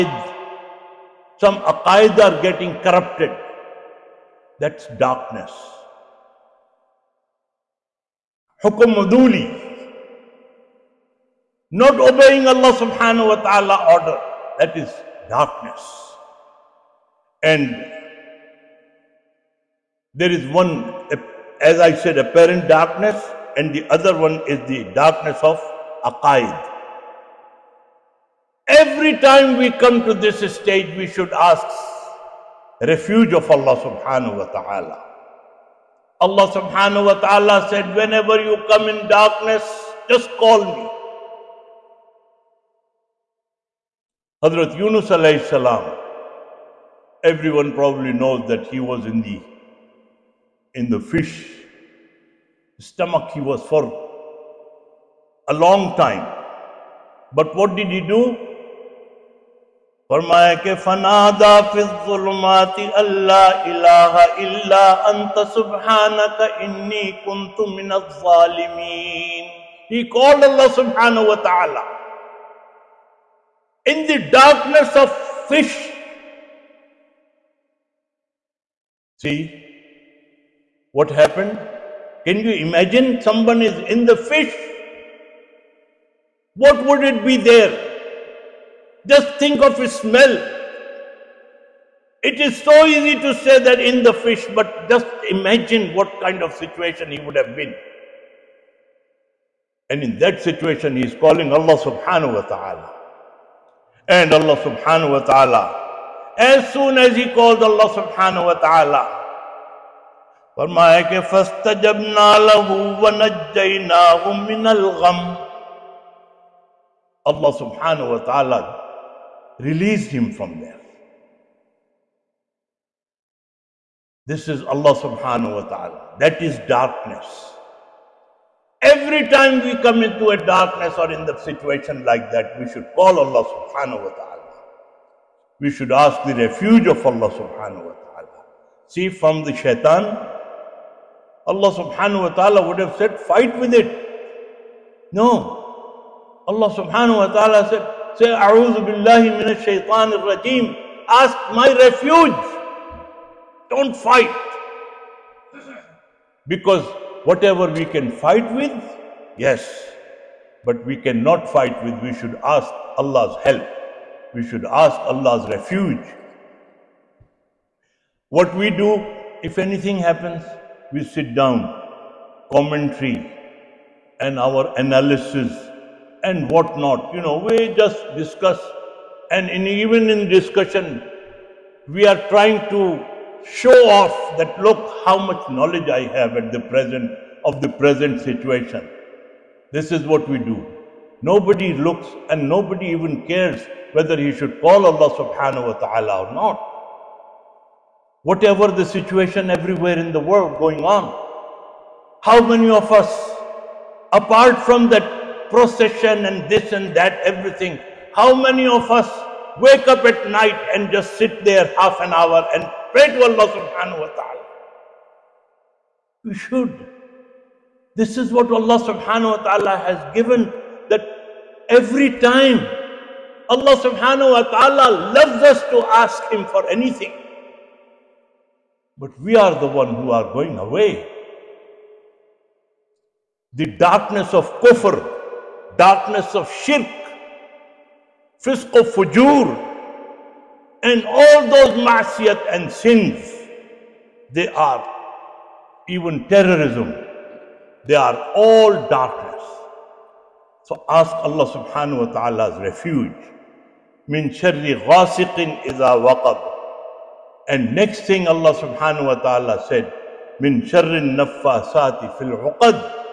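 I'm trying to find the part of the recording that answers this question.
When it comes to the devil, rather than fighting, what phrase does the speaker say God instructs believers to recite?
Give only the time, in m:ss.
2:28.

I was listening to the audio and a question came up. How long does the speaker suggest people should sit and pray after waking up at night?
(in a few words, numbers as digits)
Half an hour.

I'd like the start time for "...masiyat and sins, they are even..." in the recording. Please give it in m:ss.
4:01.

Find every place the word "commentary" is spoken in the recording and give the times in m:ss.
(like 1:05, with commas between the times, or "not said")
2:52.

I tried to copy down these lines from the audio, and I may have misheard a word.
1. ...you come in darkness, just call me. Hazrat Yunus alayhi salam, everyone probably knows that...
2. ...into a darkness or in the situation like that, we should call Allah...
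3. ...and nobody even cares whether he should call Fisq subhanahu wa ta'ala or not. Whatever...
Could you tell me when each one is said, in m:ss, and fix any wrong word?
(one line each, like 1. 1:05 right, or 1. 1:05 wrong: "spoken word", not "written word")
1. 0:38 right
2. 2:10 right
3. 3:12 wrong: "Allah", not "Fisq".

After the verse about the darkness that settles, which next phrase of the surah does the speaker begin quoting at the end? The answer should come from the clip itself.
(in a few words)
Min sharri sati fil uqad.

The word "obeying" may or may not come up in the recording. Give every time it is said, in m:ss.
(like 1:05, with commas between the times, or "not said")
0:11.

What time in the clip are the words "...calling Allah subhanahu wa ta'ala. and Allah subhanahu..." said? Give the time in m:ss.
1:41.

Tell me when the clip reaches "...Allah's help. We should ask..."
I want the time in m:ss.
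2:42.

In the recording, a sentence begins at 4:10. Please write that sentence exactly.
So ask Allah subhanahu wa ta'ala's refuge.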